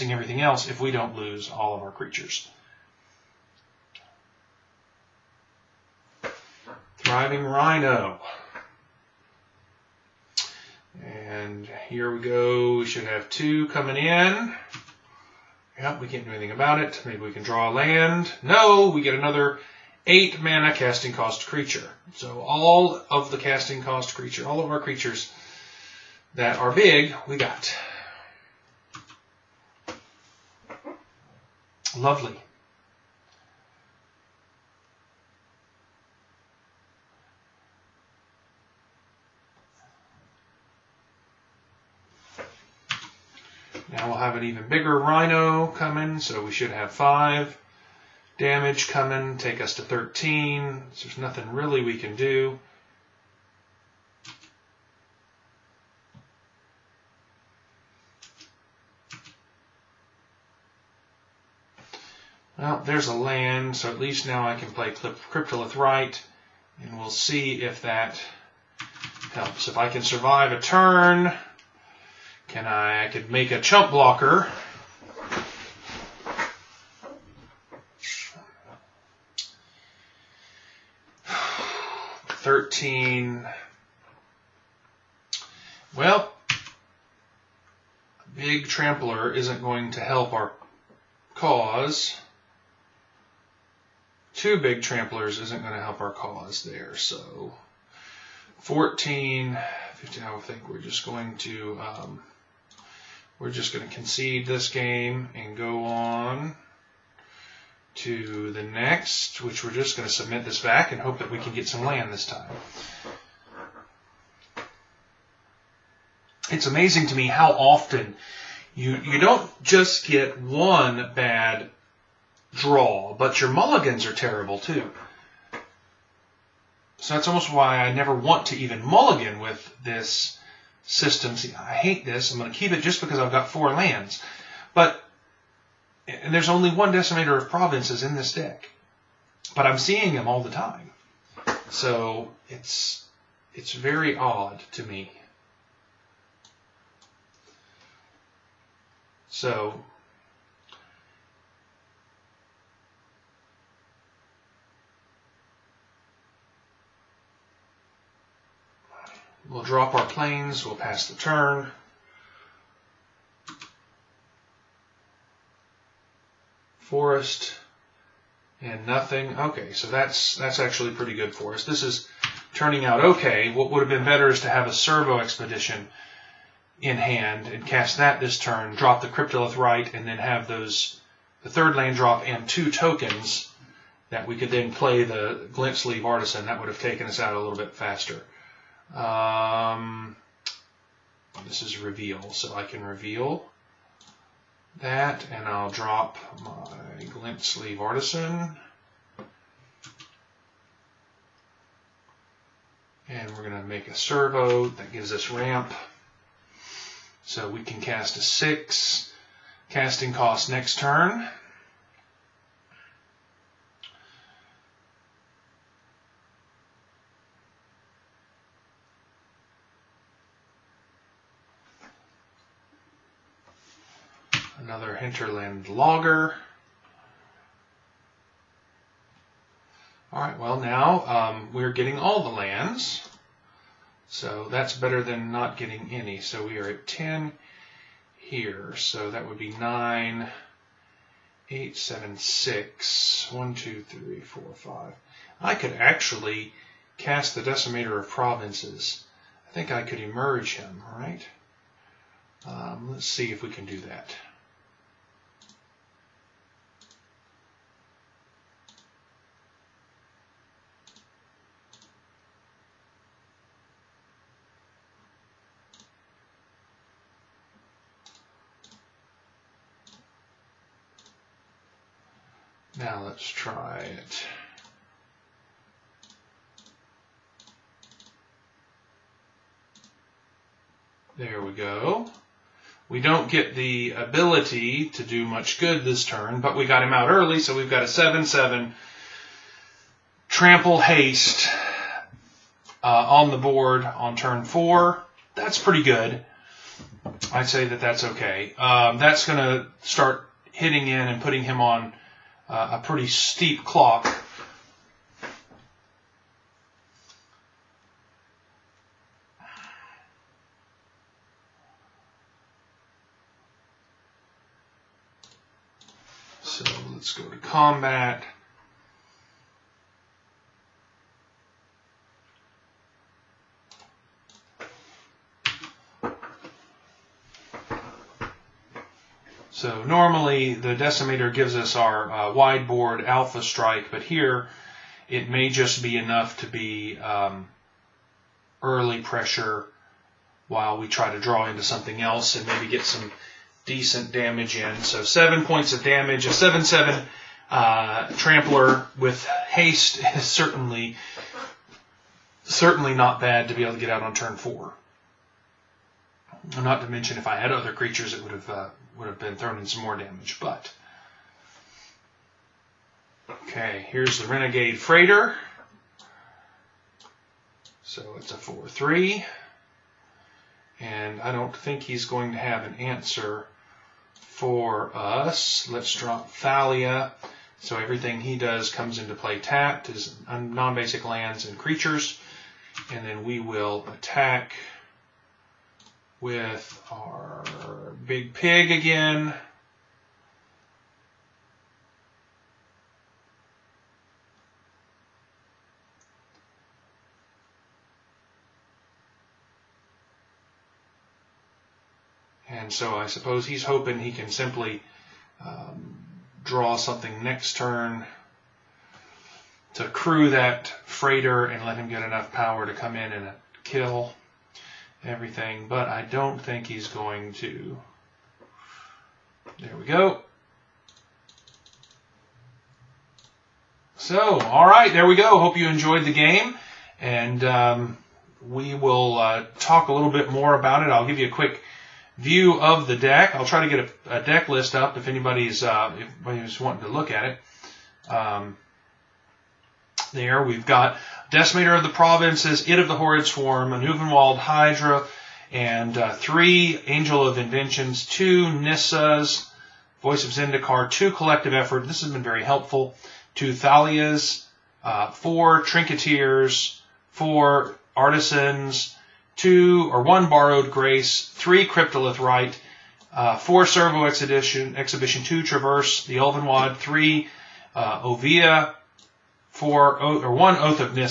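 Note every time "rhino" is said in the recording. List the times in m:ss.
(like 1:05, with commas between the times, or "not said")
0:07, 0:44.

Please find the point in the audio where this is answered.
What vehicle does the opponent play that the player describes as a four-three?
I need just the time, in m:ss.
6:04.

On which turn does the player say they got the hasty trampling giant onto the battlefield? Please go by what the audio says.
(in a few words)
Turn 4.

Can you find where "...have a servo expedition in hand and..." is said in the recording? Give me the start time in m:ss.
2:54.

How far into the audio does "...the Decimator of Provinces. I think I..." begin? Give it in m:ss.
4:07.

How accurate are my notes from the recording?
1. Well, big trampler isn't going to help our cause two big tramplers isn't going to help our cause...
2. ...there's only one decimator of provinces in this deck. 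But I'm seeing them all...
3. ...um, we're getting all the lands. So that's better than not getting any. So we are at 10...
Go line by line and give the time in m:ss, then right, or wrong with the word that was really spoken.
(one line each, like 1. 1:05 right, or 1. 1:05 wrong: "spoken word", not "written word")
1. 1:25 right
2. 2:16 right
3. 3:51 right.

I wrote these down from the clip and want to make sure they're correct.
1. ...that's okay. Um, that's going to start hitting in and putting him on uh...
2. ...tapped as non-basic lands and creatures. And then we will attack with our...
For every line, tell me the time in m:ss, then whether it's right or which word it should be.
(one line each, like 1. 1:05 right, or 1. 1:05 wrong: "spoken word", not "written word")
1. 4:57 right
2. 6:19 right.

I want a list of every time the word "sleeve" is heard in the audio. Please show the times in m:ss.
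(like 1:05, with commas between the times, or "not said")
3:05, 3:17.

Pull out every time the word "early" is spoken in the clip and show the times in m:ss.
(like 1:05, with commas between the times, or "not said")
4:47, 5:38.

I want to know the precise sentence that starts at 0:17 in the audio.
Maybe we can draw a land.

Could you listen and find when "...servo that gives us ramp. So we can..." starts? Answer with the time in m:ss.
3:23.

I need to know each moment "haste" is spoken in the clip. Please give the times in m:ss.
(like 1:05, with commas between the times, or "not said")
4:50, 5:49.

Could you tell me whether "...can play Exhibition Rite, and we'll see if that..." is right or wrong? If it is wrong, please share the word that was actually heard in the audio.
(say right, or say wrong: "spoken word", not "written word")
wrong: "Cryptolith", not "Exhibition".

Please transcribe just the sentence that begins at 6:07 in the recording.
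So it's a four three, and I don't think he's going to have an answer for us.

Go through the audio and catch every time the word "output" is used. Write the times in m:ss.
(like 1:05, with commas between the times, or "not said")
not said.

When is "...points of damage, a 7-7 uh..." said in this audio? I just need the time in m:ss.
5:45.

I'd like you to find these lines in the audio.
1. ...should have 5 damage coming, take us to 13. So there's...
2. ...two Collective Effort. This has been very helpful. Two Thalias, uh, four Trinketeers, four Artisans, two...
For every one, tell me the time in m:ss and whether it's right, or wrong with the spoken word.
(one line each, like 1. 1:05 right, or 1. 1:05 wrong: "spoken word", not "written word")
1. 0:46 right
2. 7:30 right.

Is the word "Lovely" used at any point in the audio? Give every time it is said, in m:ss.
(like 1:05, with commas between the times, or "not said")
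0:31.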